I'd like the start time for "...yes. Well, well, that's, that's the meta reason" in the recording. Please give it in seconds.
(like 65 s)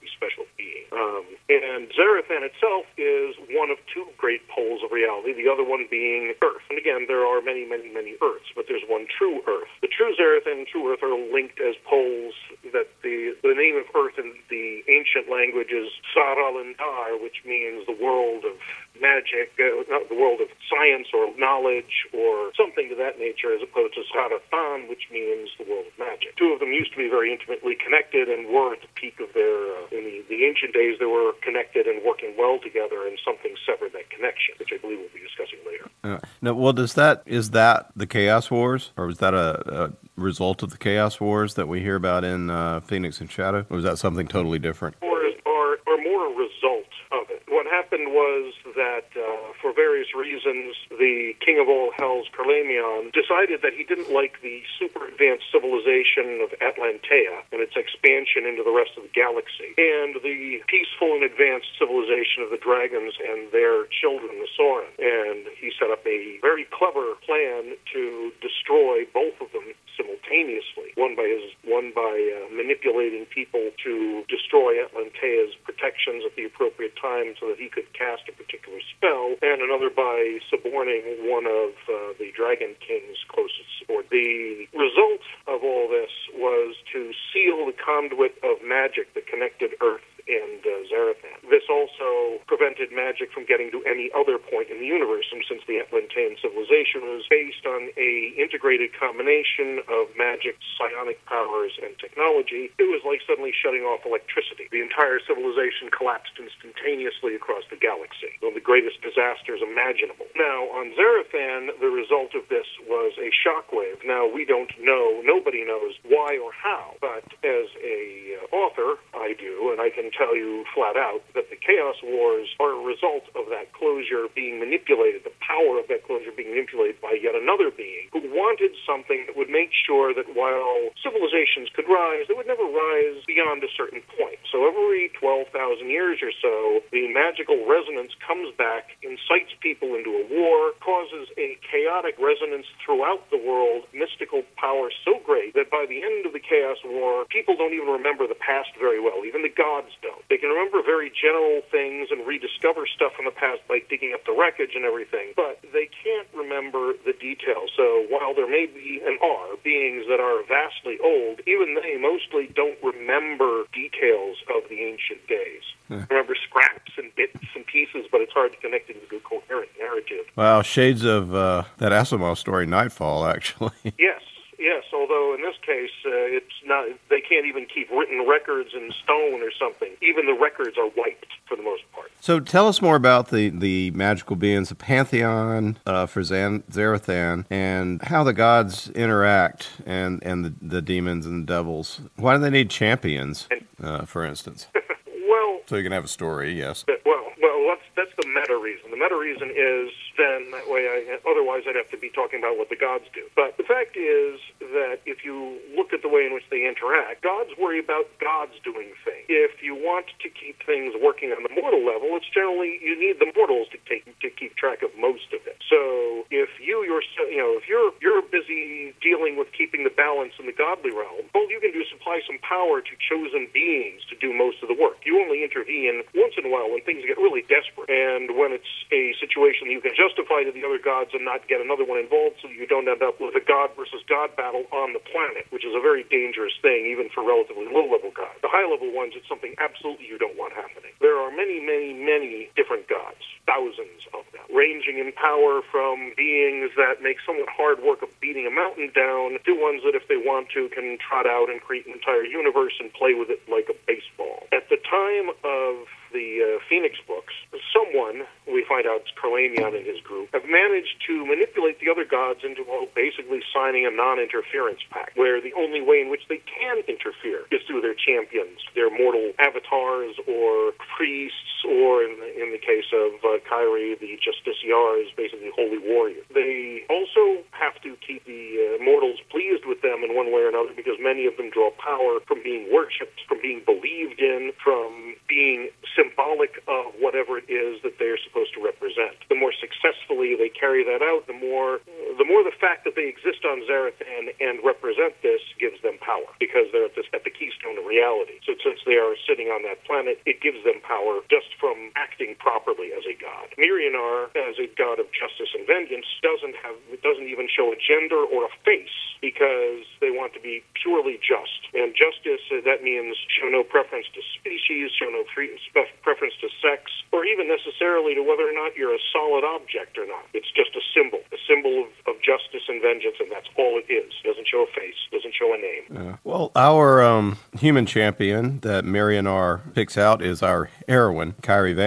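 196 s.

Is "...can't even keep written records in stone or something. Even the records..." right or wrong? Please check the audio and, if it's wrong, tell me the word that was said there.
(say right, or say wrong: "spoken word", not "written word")
right.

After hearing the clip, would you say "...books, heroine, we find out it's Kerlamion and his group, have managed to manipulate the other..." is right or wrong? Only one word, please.
wrong.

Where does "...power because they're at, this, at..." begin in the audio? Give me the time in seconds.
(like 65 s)
296 s.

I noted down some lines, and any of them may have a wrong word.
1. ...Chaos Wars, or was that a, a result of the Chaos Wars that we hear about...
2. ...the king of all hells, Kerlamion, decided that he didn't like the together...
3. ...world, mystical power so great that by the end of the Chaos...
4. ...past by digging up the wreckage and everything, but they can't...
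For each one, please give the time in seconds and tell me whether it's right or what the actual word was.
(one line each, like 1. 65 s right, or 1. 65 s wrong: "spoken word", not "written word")
1. 38 s right
2. 50 s wrong: "super", not "together"
3. 143 s right
4. 153 s right.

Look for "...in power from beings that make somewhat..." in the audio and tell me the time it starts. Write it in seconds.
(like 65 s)
244 s.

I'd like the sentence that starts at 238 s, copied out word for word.
The high level ones, it's something absolutely you don't want happening.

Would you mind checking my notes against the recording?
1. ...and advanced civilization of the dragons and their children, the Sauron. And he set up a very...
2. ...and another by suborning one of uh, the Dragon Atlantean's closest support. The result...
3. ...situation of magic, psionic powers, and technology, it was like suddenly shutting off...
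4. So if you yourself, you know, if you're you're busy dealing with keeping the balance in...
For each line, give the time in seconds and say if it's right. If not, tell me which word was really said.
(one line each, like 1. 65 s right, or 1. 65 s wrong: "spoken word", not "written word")
1. 61 s right
2. 79 s wrong: "King", not "Atlantean"
3. 98 s wrong: "combination", not "situation"
4. 215 s right.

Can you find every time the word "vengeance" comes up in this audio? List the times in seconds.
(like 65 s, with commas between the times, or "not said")
305 s, 322 s.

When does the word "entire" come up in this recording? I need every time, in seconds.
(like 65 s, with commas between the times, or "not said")
104 s, 251 s.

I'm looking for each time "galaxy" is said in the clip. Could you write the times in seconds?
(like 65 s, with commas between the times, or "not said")
59 s, 107 s.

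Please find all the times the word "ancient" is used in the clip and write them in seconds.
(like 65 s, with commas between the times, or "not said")
14 s, 30 s, 164 s.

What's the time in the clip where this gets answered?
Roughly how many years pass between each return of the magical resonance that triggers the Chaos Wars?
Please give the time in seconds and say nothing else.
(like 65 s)
135 s.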